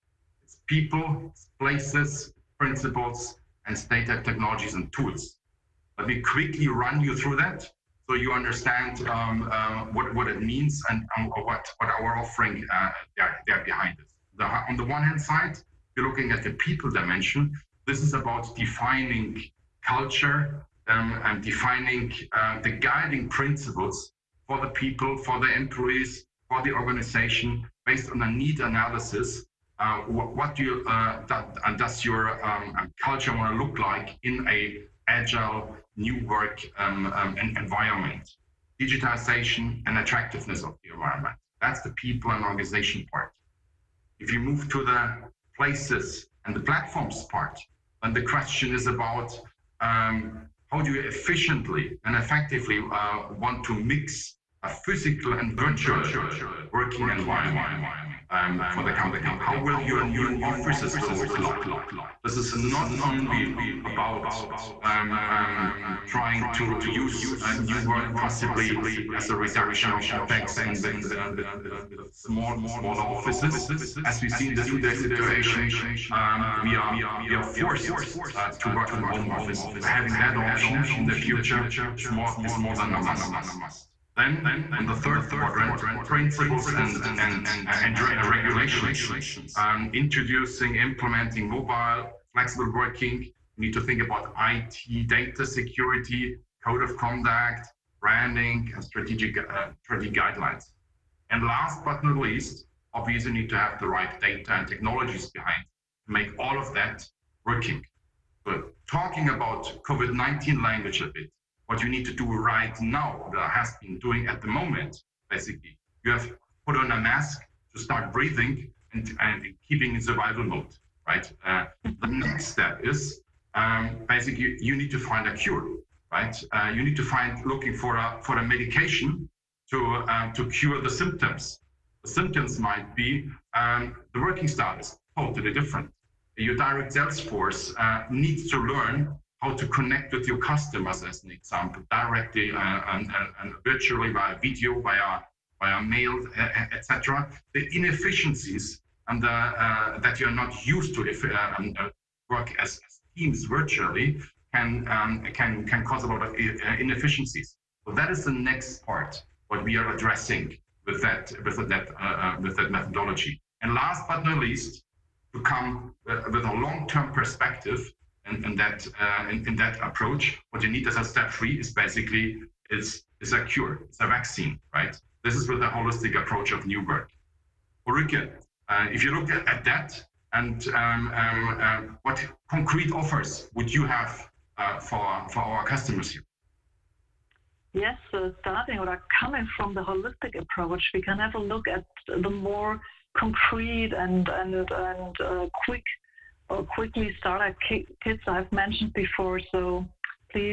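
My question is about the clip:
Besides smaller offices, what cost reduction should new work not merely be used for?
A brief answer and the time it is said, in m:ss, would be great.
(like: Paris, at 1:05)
OPEX, at 1:10.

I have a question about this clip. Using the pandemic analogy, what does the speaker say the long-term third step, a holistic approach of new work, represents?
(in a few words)
A vaccine.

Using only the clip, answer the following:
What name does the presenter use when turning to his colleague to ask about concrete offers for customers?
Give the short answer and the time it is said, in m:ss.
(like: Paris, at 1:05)
Ulrike, at 2:57.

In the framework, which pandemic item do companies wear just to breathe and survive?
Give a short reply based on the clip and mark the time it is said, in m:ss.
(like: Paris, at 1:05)
A mask, at 1:56.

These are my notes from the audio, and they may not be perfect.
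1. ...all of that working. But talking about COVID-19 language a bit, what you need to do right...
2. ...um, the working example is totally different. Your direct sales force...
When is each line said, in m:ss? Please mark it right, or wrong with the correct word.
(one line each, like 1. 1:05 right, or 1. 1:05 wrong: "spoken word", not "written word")
1. 1:46 right
2. 2:13 wrong: "style", not "example".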